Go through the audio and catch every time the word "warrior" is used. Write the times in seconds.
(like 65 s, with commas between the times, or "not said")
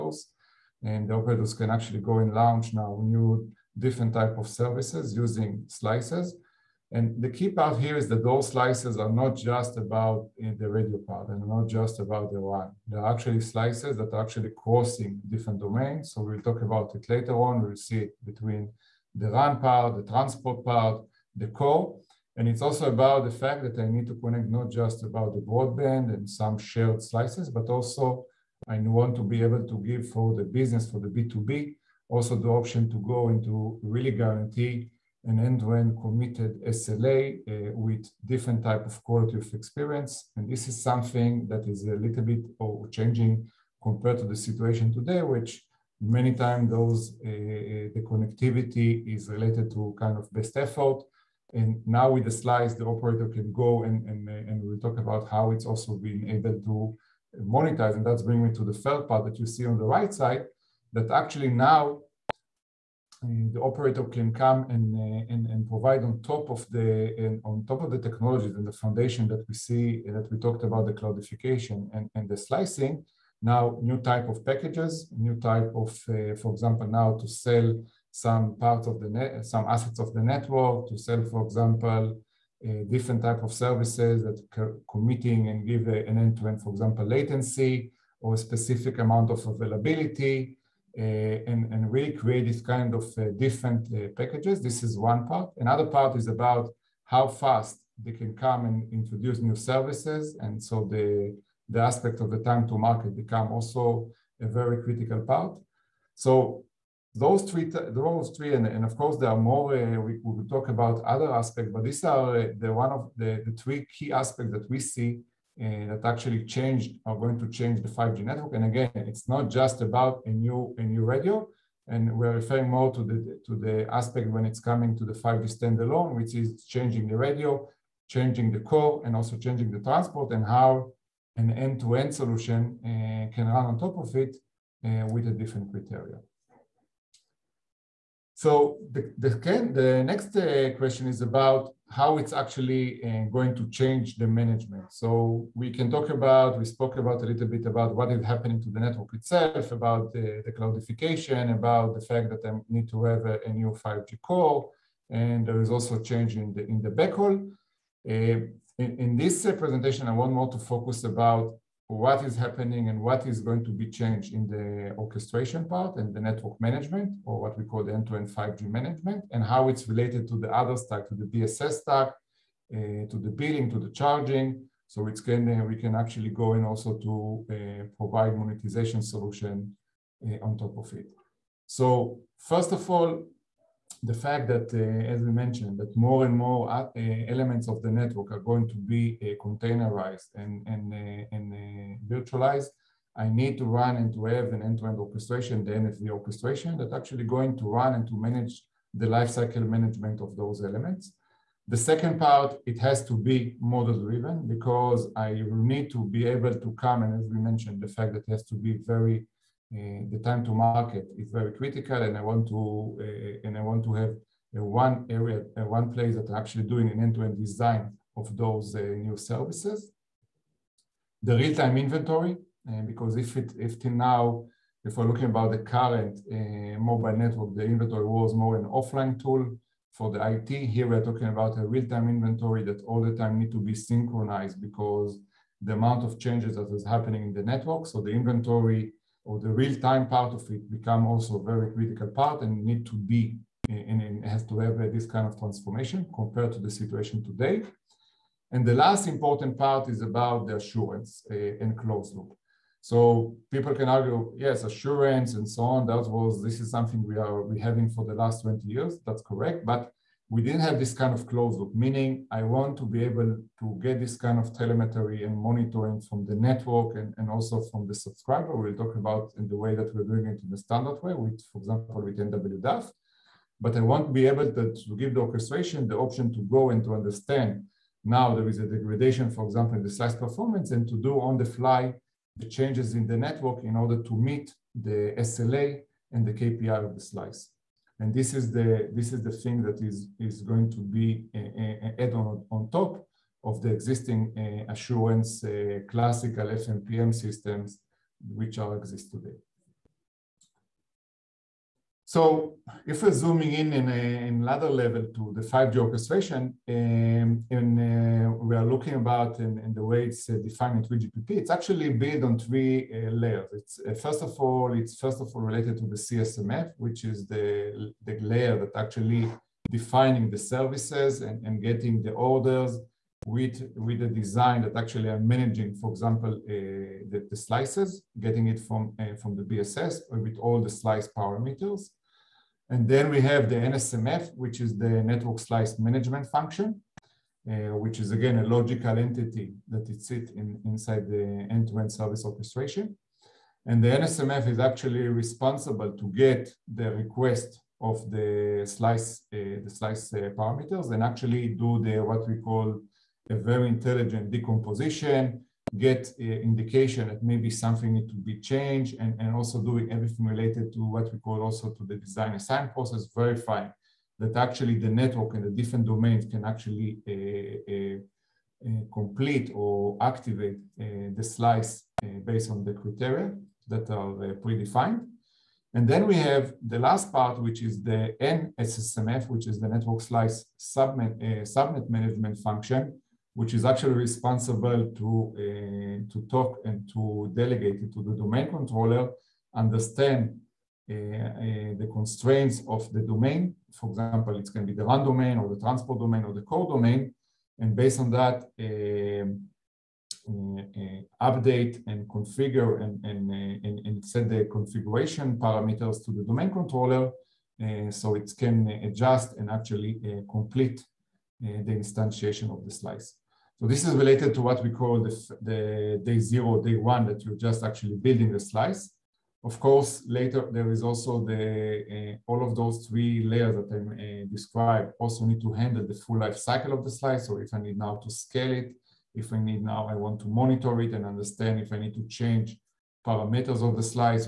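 not said.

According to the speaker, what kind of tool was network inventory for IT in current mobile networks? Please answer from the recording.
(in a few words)
Offline tool.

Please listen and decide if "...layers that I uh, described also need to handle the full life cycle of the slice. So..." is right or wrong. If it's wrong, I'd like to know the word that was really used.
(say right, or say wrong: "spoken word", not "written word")
right.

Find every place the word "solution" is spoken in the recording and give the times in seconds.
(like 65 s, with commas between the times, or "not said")
132 s, 179 s.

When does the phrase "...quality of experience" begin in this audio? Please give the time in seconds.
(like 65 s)
39 s.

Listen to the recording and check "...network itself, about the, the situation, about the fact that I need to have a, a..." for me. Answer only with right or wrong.
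wrong.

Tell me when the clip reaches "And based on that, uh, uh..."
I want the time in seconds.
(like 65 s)
397 s.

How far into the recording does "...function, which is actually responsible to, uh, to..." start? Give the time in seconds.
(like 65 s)
382 s.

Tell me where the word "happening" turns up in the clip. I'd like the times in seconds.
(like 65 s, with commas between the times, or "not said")
148 s, 162 s, 236 s.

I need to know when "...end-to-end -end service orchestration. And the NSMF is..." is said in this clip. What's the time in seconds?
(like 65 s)
341 s.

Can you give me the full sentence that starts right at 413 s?
So this is related to what we call the, the day zero, day one, that you're just actually building the slice.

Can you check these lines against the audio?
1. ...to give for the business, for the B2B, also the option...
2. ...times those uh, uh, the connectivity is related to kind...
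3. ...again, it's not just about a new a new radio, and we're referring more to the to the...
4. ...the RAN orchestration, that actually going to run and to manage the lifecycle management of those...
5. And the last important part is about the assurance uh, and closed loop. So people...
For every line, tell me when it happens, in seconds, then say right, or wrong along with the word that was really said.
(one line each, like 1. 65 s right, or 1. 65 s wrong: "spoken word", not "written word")
1. 29 s right
2. 46 s right
3. 118 s right
4. 195 s wrong: "NFV", not "RAN"
5. 248 s right.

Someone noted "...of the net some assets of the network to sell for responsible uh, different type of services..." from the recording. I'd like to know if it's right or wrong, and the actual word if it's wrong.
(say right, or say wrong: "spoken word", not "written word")
wrong: "example", not "responsible".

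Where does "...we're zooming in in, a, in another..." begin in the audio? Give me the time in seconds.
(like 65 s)
303 s.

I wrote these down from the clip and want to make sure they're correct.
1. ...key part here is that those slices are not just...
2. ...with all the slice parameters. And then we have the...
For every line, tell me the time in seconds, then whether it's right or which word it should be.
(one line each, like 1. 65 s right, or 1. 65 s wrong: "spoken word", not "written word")
1. 7 s right
2. 330 s right.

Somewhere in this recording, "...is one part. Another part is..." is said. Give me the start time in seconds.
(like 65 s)
94 s.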